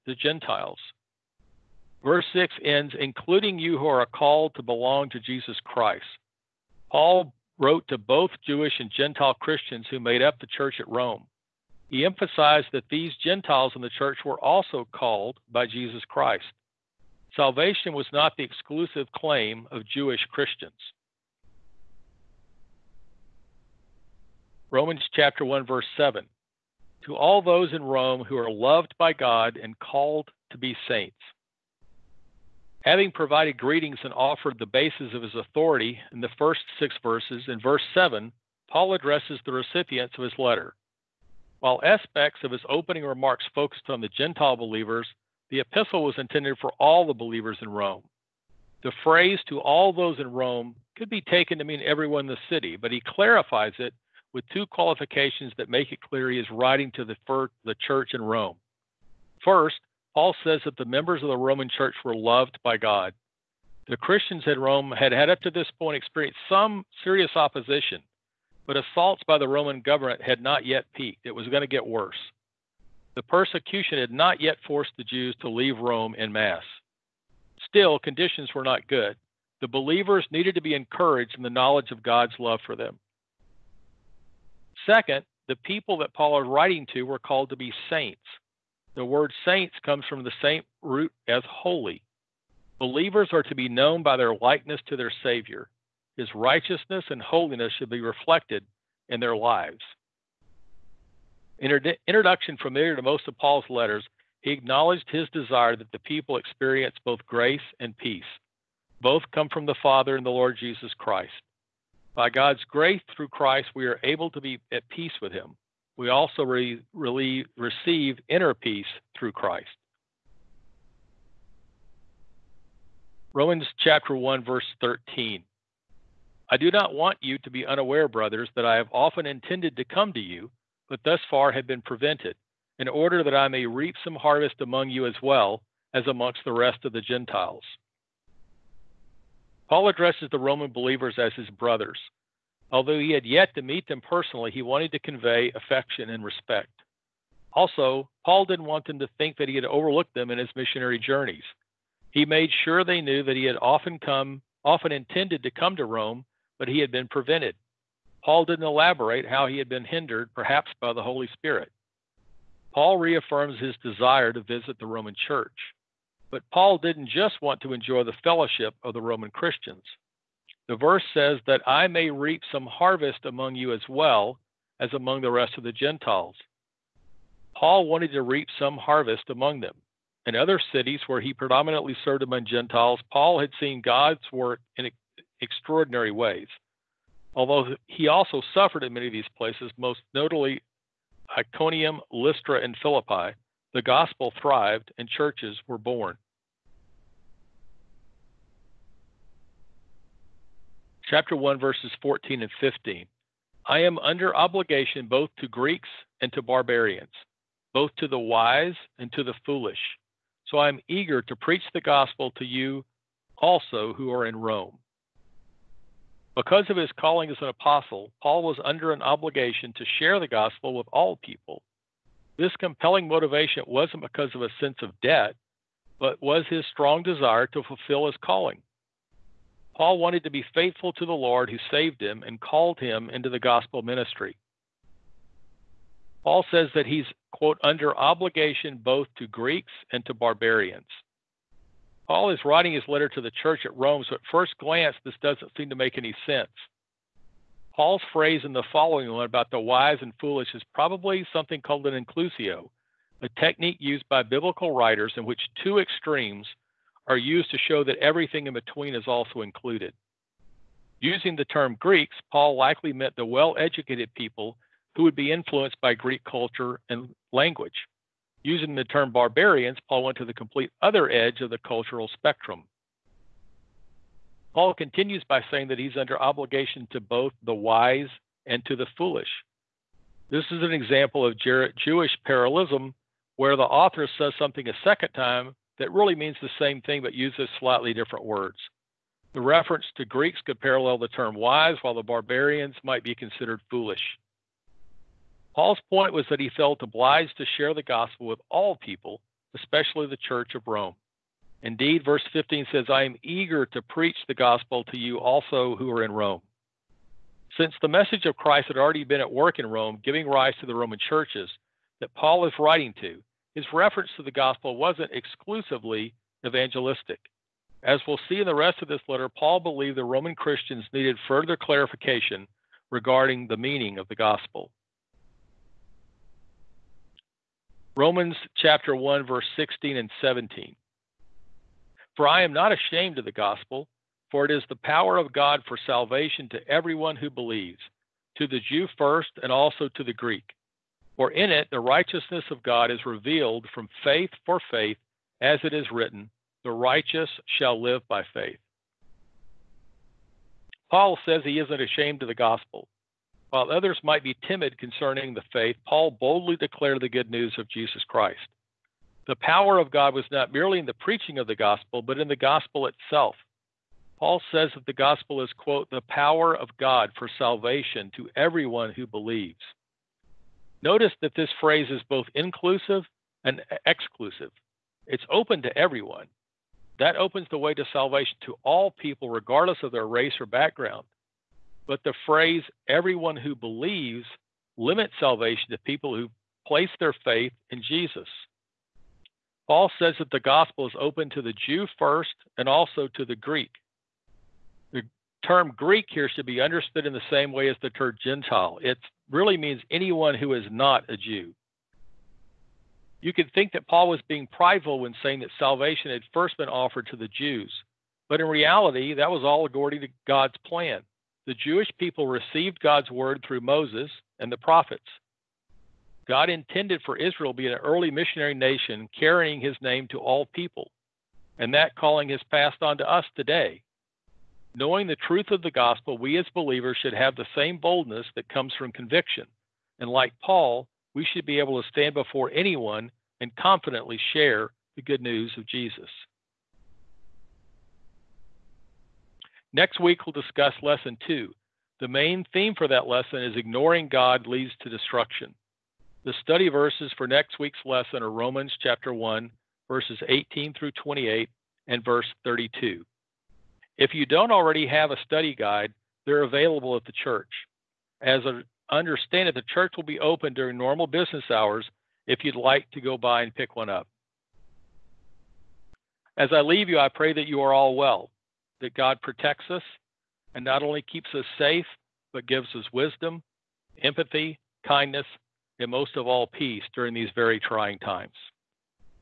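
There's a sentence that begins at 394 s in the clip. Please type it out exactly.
The term Greek here should be understood in the same way as the term Gentile.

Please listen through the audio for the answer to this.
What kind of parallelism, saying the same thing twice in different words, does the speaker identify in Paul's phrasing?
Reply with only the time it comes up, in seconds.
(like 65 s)
281 s.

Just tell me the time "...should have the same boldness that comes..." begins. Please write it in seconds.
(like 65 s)
427 s.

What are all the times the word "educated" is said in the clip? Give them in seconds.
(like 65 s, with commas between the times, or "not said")
263 s.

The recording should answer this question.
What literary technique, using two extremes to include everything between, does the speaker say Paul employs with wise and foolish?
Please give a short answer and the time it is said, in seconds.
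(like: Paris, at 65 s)
inclusio, at 252 s.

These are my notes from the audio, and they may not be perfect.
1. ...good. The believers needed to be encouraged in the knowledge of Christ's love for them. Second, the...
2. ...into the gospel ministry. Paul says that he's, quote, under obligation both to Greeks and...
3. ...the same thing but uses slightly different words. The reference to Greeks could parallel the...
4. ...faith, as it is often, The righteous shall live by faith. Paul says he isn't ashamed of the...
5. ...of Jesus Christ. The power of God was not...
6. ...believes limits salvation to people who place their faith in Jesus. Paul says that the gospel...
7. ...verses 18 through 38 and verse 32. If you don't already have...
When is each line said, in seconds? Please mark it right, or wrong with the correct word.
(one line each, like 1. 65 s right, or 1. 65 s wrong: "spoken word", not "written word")
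1. 78 s wrong: "God", not "Christ"
2. 233 s right
3. 286 s right
4. 344 s wrong: "written", not "often"
5. 357 s right
6. 383 s right
7. 449 s wrong: "28", not "38".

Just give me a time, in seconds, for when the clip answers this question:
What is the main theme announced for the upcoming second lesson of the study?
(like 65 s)
443 s.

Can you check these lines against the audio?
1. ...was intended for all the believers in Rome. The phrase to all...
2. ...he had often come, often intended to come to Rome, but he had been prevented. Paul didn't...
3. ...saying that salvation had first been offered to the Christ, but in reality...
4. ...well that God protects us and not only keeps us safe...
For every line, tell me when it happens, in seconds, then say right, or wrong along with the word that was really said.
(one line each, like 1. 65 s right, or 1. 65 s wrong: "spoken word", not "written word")
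1. 46 s right
2. 153 s right
3. 405 s wrong: "Jews", not "Christ"
4. 467 s right.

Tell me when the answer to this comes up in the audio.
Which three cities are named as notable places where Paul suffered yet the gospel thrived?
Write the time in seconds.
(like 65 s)
191 s.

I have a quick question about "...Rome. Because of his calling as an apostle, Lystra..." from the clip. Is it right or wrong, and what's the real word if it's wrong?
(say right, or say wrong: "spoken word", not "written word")
wrong: "Paul", not "Lystra".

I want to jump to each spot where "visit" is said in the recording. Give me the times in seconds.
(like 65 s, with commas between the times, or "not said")
164 s.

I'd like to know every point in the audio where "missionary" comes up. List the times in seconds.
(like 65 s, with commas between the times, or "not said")
150 s, 418 s.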